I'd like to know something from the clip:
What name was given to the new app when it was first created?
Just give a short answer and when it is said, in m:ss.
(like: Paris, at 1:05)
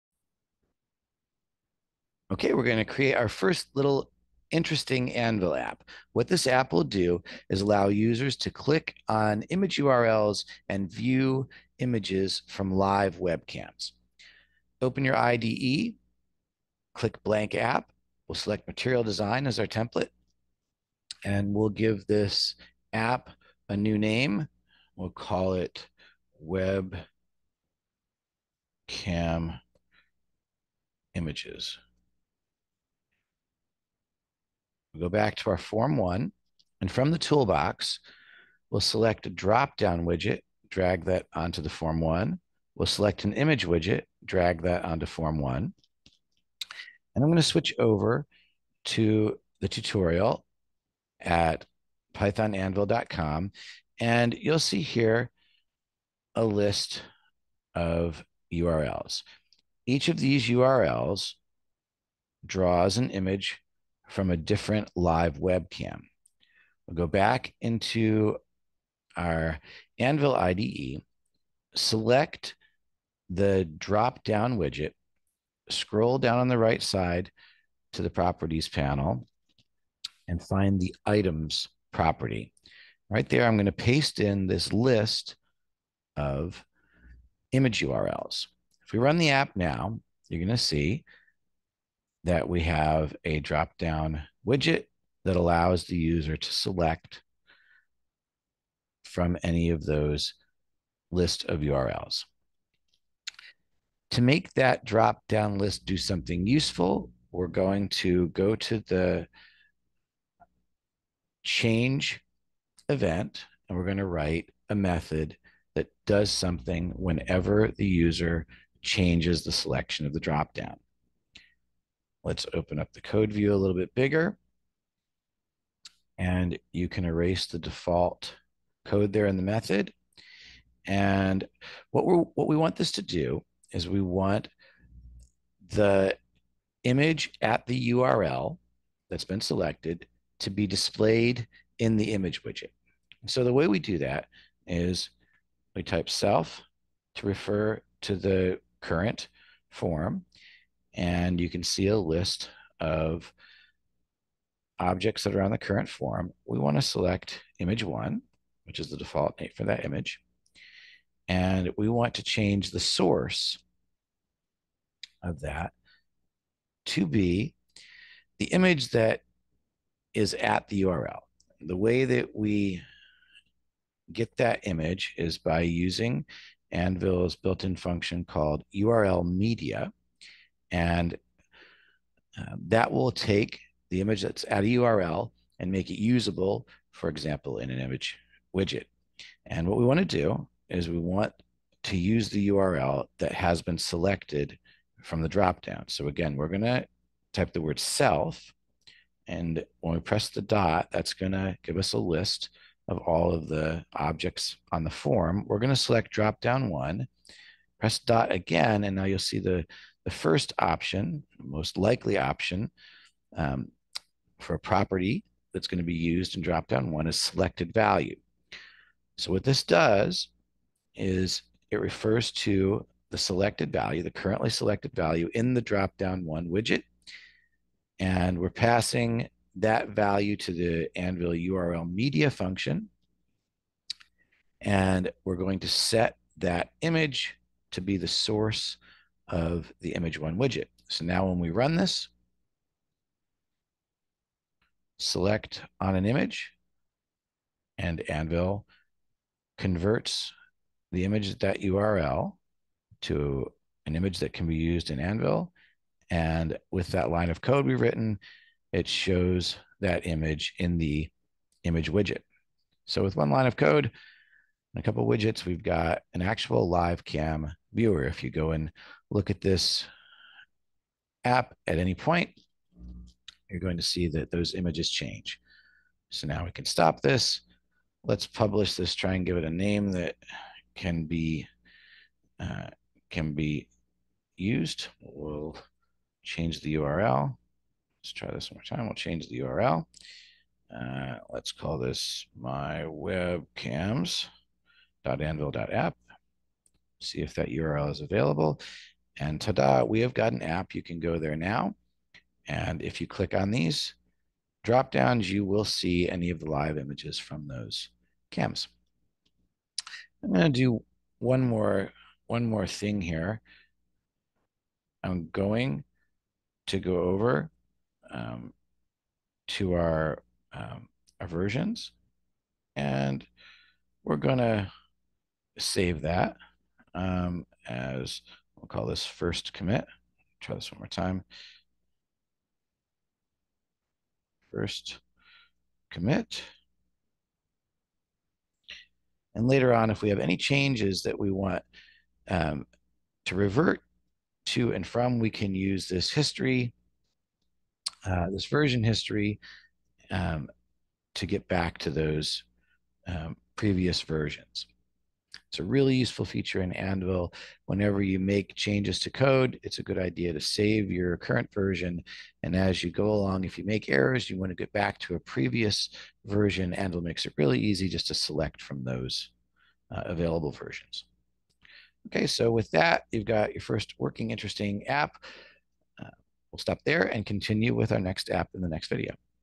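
Webcam images, at 0:26.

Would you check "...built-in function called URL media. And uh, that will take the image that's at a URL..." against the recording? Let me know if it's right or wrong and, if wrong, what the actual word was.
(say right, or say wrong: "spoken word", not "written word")
right.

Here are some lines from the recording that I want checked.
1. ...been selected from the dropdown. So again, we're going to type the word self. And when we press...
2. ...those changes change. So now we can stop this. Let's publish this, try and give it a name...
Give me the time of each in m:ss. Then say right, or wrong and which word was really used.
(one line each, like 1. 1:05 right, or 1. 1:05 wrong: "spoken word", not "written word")
1. 3:13 right
2. 4:34 wrong: "images", not "changes".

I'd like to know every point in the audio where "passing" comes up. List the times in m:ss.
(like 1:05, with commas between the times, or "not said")
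3:48.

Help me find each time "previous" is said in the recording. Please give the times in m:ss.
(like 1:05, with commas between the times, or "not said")
5:53, 6:05.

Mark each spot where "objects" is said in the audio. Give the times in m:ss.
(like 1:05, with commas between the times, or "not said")
2:34, 3:23.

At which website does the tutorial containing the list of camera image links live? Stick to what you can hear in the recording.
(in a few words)
pythonanvil.com.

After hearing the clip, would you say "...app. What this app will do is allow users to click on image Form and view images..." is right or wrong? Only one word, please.
wrong.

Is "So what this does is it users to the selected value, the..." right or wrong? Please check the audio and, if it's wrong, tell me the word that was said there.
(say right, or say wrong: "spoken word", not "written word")
wrong: "refers", not "users".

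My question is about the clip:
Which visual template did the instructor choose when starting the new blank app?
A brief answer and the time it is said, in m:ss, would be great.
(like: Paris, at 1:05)
Material design, at 0:18.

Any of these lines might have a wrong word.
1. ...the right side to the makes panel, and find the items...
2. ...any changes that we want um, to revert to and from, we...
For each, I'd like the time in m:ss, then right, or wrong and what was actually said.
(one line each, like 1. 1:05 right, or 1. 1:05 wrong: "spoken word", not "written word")
1. 1:16 wrong: "properties", not "makes"
2. 5:40 right.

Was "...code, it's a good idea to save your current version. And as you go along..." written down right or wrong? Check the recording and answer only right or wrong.
right.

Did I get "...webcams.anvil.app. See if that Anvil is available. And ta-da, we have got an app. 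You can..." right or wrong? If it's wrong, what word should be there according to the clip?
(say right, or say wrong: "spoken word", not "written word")
wrong: "URL", not "Anvil".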